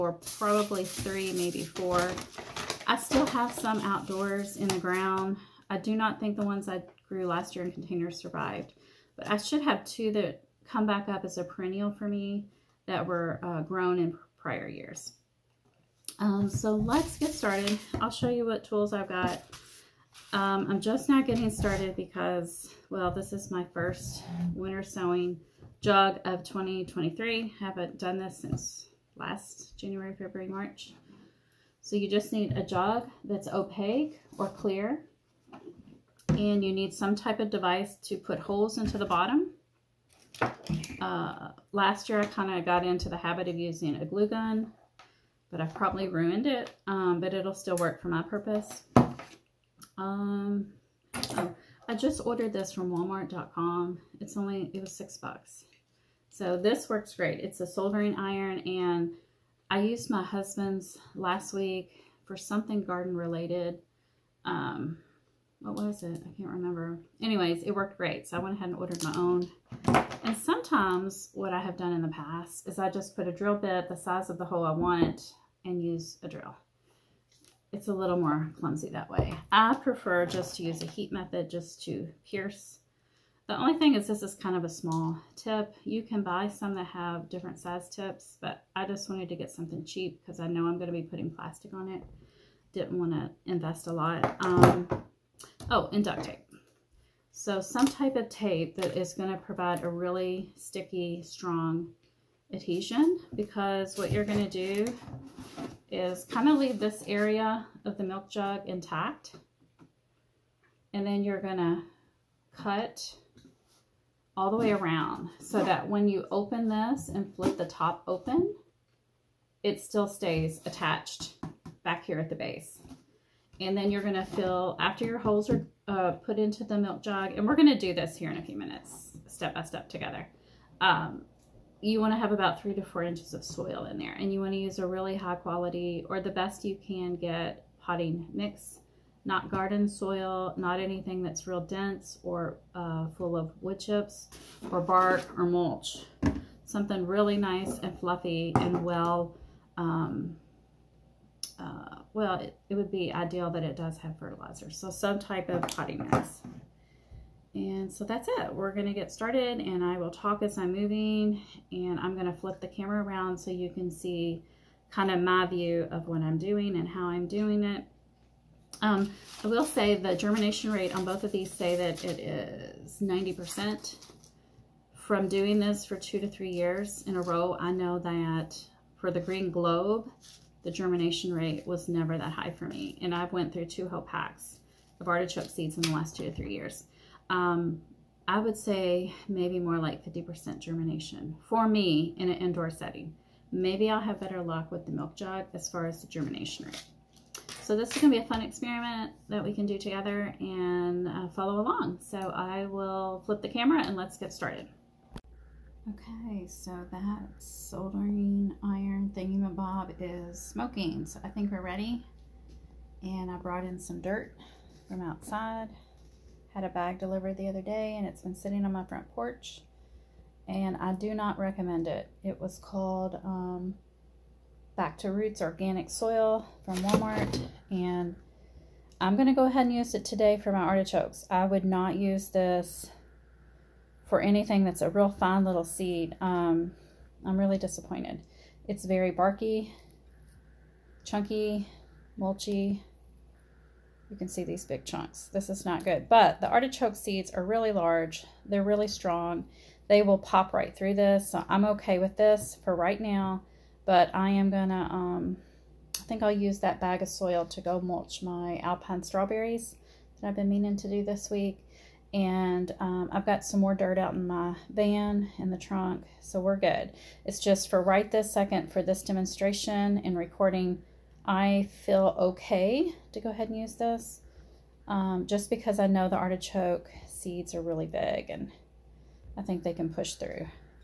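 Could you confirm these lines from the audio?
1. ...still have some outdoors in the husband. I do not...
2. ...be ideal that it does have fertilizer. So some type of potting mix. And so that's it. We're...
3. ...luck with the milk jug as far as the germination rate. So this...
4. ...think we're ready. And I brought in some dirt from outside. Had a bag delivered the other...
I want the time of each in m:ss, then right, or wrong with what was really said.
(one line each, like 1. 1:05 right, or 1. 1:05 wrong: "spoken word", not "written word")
1. 0:02 wrong: "ground", not "husband"
2. 2:32 right
3. 3:14 right
4. 3:31 right.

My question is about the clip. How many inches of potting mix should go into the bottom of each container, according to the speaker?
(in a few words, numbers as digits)
3 to 4 inches.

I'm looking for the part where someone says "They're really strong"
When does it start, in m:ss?
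4:08.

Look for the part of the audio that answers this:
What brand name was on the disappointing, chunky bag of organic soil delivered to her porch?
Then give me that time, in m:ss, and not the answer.
3:44.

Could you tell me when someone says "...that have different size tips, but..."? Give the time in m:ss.
1:26.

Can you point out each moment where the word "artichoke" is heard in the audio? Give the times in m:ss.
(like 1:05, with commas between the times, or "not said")
3:05, 3:50, 4:06, 4:36.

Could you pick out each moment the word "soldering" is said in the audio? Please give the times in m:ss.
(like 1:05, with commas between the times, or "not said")
0:57, 3:27.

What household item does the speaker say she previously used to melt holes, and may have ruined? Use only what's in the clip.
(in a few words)
glue gun.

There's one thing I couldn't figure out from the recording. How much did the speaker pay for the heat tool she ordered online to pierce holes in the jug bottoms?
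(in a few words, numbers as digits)
$6.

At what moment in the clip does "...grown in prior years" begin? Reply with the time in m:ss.
0:13.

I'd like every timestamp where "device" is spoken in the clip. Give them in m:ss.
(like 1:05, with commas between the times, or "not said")
0:37.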